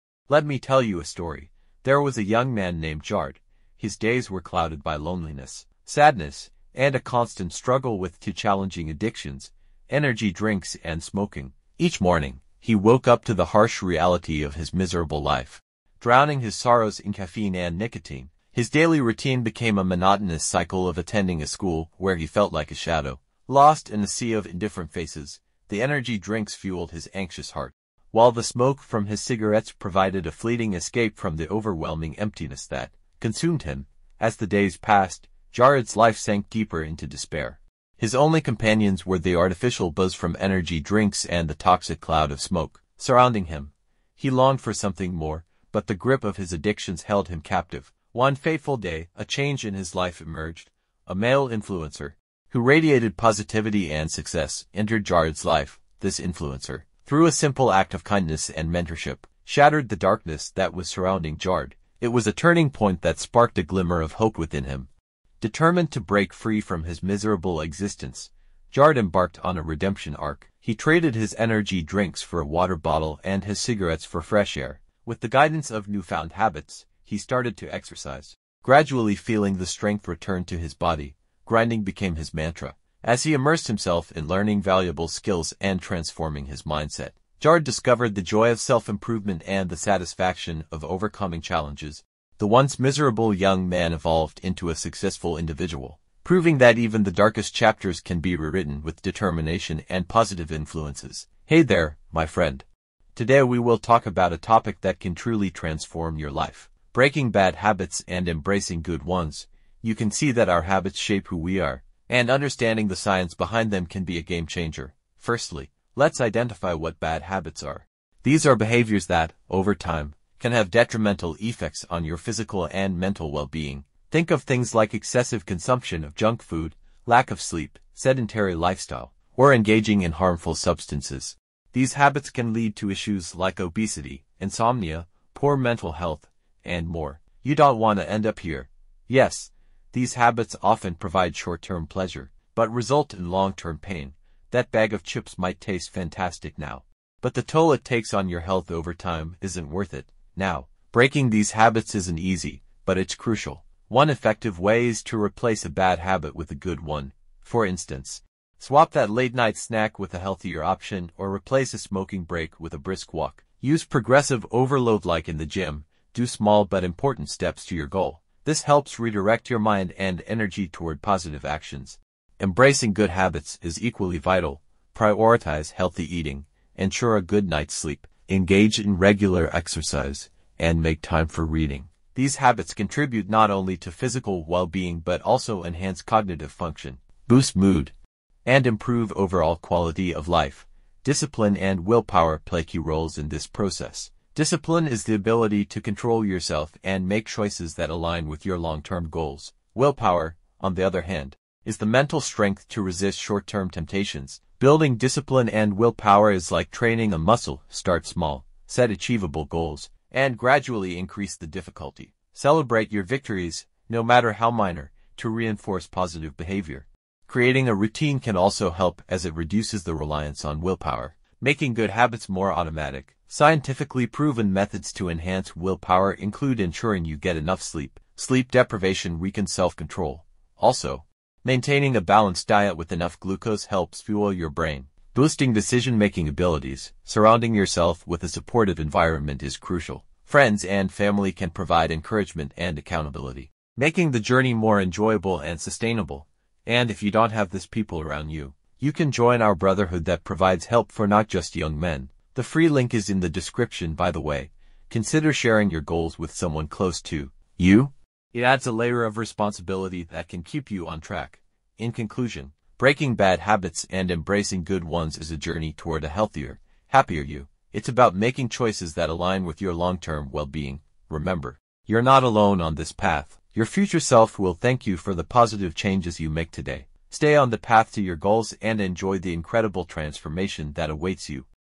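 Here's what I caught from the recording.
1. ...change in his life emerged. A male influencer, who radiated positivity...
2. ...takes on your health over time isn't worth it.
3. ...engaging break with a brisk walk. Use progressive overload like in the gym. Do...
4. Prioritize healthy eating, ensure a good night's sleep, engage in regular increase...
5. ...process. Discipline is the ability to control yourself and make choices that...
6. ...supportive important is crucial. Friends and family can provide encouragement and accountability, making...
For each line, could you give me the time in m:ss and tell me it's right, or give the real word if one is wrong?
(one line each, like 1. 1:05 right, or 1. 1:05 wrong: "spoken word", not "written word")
1. 0:49 right
2. 2:27 right
3. 2:41 wrong: "smoking", not "engaging"
4. 2:54 wrong: "exercise", not "increase"
5. 3:13 right
6. 3:58 wrong: "environment", not "important".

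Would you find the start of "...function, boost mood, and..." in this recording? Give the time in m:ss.
3:06.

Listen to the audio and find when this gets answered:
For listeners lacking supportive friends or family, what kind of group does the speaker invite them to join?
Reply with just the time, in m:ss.
4:09.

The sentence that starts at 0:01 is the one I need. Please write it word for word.
There was a young man named Jared.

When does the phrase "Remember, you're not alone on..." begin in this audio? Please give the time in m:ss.
4:31.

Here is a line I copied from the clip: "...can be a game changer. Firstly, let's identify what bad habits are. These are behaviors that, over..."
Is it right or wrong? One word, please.
right.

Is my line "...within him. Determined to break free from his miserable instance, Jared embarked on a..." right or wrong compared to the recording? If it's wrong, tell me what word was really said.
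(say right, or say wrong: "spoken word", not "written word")
wrong: "existence", not "instance".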